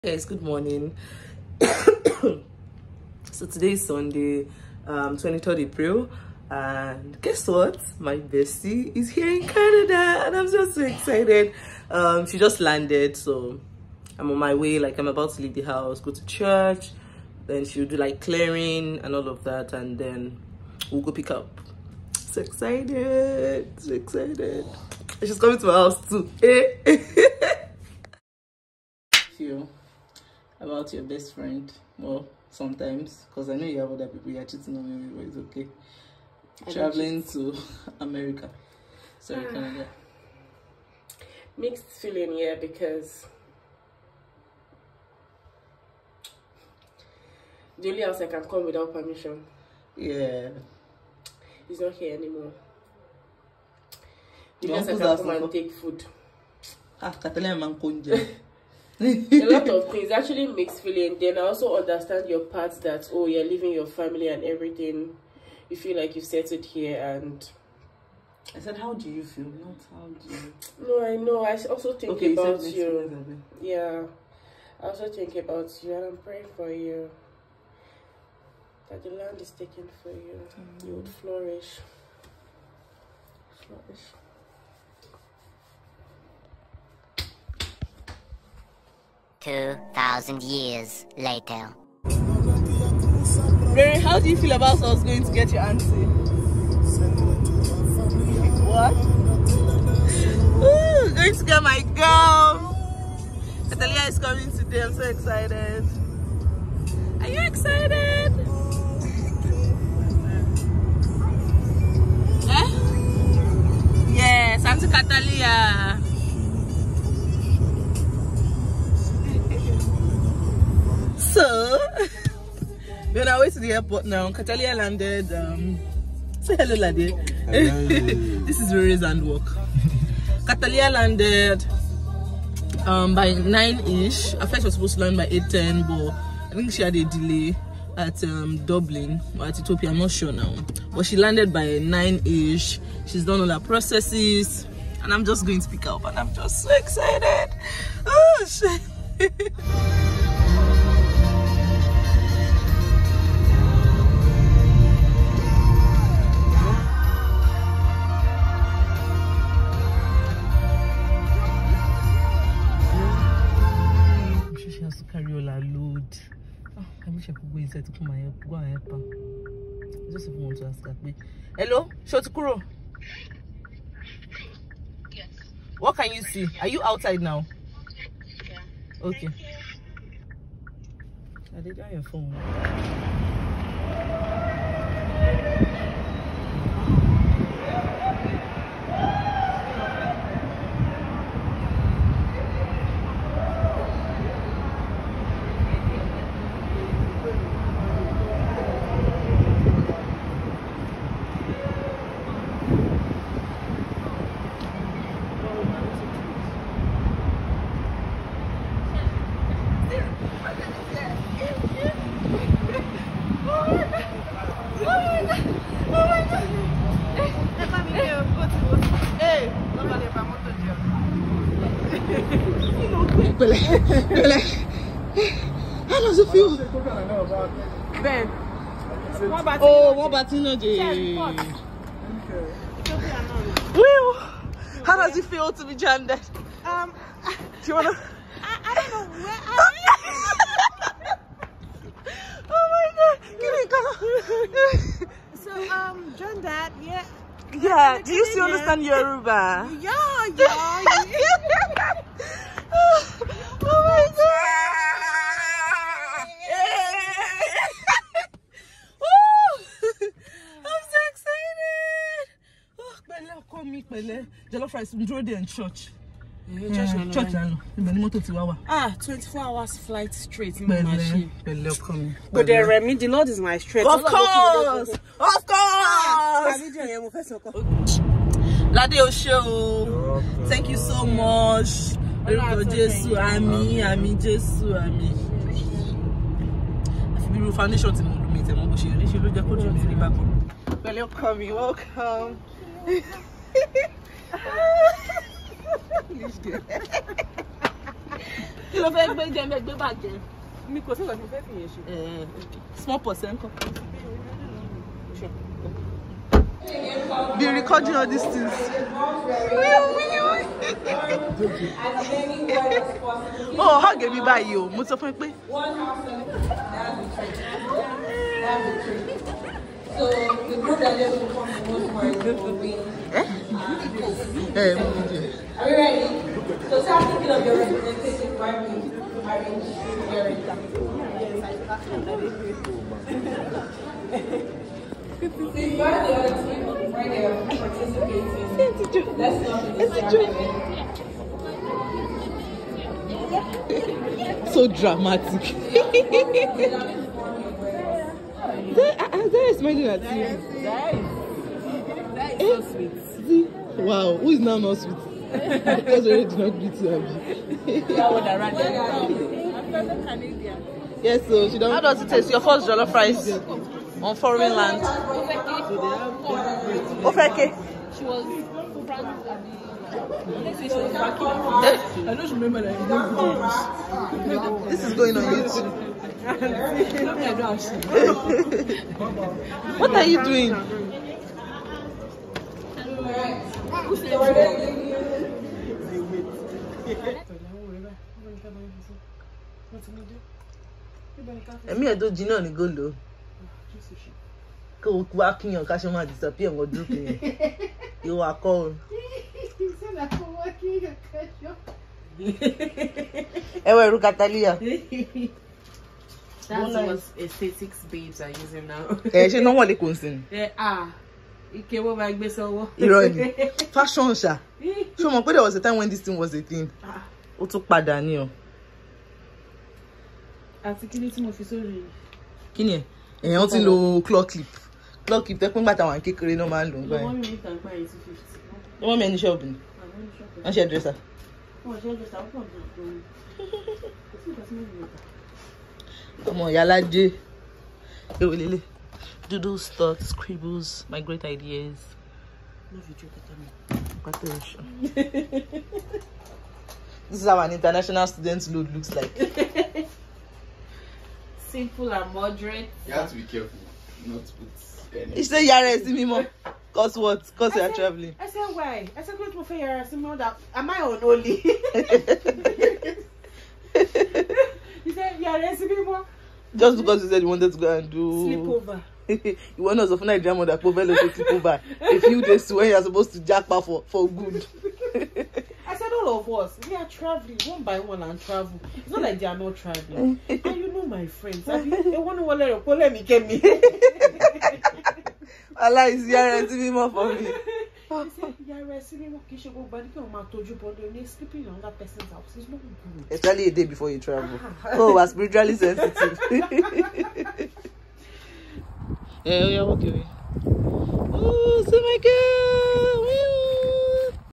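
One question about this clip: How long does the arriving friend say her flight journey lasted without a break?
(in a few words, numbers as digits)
24 hours.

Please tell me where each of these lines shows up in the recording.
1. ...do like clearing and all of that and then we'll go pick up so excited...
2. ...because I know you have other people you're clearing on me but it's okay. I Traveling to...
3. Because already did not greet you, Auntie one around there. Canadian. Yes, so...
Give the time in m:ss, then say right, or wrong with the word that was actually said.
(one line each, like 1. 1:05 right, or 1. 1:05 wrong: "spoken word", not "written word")
1. 0:17 right
2. 0:33 wrong: "cheating", not "clearing"
3. 5:55 wrong: "That", not "Auntie".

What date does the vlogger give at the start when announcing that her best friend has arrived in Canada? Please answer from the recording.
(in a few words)
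23rd April.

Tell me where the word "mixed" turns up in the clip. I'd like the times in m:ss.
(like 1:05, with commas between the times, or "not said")
0:41, 1:00.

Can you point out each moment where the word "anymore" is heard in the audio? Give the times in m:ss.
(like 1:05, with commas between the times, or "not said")
0:52.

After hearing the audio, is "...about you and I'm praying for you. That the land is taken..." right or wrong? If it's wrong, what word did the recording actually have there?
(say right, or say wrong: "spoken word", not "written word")
right.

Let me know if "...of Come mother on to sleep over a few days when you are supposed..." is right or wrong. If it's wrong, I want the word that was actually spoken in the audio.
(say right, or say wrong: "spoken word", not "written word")
wrong: "Nigerian", not "Come".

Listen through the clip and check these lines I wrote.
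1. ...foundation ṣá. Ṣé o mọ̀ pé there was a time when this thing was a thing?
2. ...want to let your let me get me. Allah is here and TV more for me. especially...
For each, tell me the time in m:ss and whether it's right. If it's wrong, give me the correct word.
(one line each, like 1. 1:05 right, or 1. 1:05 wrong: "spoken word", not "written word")
1. 6:53 wrong: "fashion", not "foundation"
2. 8:01 right.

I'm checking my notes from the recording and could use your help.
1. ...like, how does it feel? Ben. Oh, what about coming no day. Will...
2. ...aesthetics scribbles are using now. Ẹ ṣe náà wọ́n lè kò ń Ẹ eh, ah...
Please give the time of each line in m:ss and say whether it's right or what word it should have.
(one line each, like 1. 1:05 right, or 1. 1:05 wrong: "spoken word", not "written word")
1. 3:44 wrong: "batting", not "coming"
2. 6:47 wrong: "babes", not "scribbles".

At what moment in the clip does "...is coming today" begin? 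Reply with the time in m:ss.
1:44.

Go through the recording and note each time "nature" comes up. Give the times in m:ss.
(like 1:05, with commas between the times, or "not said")
not said.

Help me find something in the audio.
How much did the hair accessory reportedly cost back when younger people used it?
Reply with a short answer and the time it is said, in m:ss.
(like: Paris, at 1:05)
250, at 7:07.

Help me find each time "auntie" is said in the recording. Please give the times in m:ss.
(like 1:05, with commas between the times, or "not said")
1:35, 1:54.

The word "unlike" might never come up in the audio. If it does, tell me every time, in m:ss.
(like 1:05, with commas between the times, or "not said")
not said.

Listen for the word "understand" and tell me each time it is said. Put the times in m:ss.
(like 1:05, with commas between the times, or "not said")
1:01, 4:08.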